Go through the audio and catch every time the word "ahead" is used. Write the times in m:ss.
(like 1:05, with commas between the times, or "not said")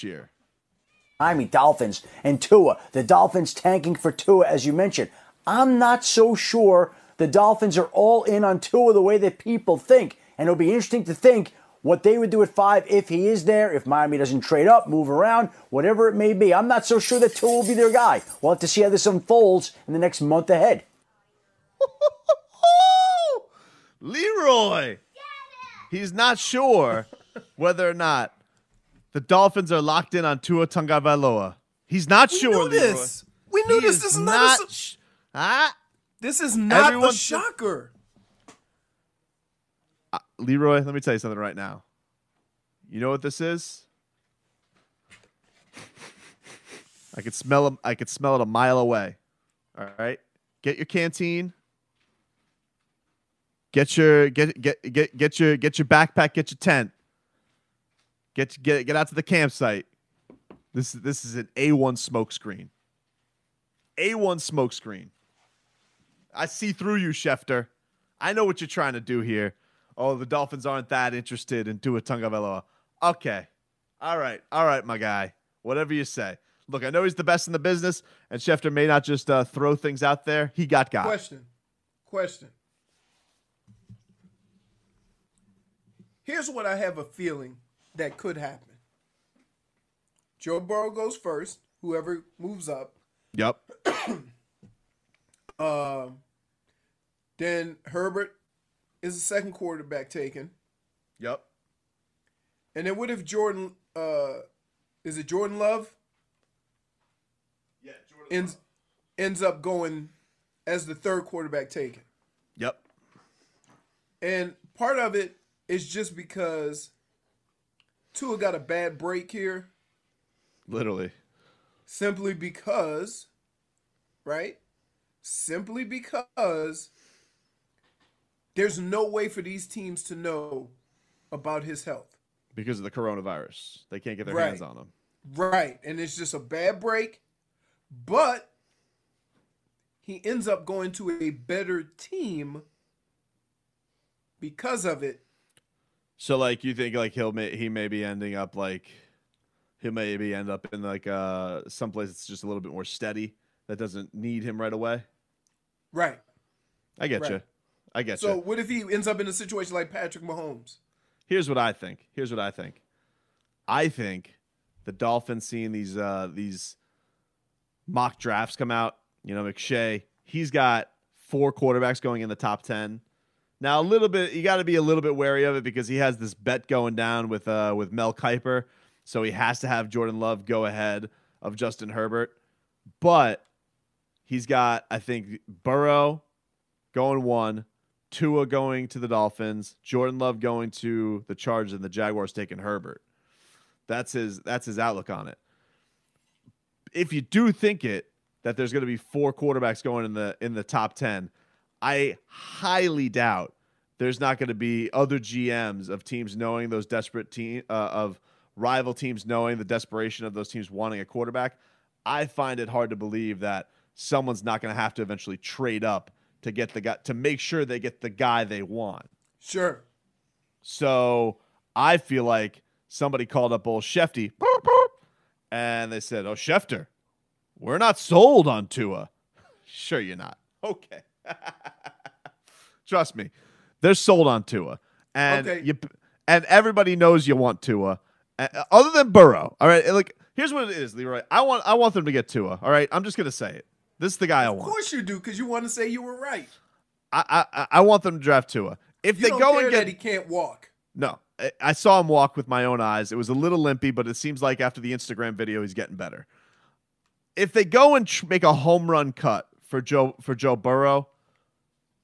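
0:20, 3:00.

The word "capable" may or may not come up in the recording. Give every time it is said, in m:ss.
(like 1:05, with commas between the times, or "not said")
not said.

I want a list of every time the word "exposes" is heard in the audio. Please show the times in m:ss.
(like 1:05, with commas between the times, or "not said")
not said.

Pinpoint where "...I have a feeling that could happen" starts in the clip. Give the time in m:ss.
1:26.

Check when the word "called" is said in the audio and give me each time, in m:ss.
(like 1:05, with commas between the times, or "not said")
3:43.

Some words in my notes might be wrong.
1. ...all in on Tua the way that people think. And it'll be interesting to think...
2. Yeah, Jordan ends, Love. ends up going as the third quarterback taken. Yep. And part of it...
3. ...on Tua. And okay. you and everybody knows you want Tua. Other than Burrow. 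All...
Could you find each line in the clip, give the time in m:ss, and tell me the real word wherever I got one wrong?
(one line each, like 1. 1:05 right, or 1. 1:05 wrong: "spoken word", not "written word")
1. 0:07 right
2. 1:47 right
3. 3:54 right.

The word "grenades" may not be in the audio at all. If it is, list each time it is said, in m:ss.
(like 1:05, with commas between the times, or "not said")
not said.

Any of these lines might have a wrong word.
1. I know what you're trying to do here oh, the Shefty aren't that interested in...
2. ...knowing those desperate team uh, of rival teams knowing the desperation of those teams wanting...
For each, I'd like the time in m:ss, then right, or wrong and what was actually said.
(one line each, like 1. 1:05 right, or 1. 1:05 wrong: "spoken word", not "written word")
1. 1:08 wrong: "Dolphins", not "Shefty"
2. 3:26 right.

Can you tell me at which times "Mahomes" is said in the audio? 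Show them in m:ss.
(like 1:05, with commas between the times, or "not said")
2:40.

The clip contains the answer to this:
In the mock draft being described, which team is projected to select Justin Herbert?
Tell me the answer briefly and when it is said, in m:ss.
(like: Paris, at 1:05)
Jaguars, at 3:11.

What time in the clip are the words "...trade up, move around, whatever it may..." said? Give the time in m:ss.
0:14.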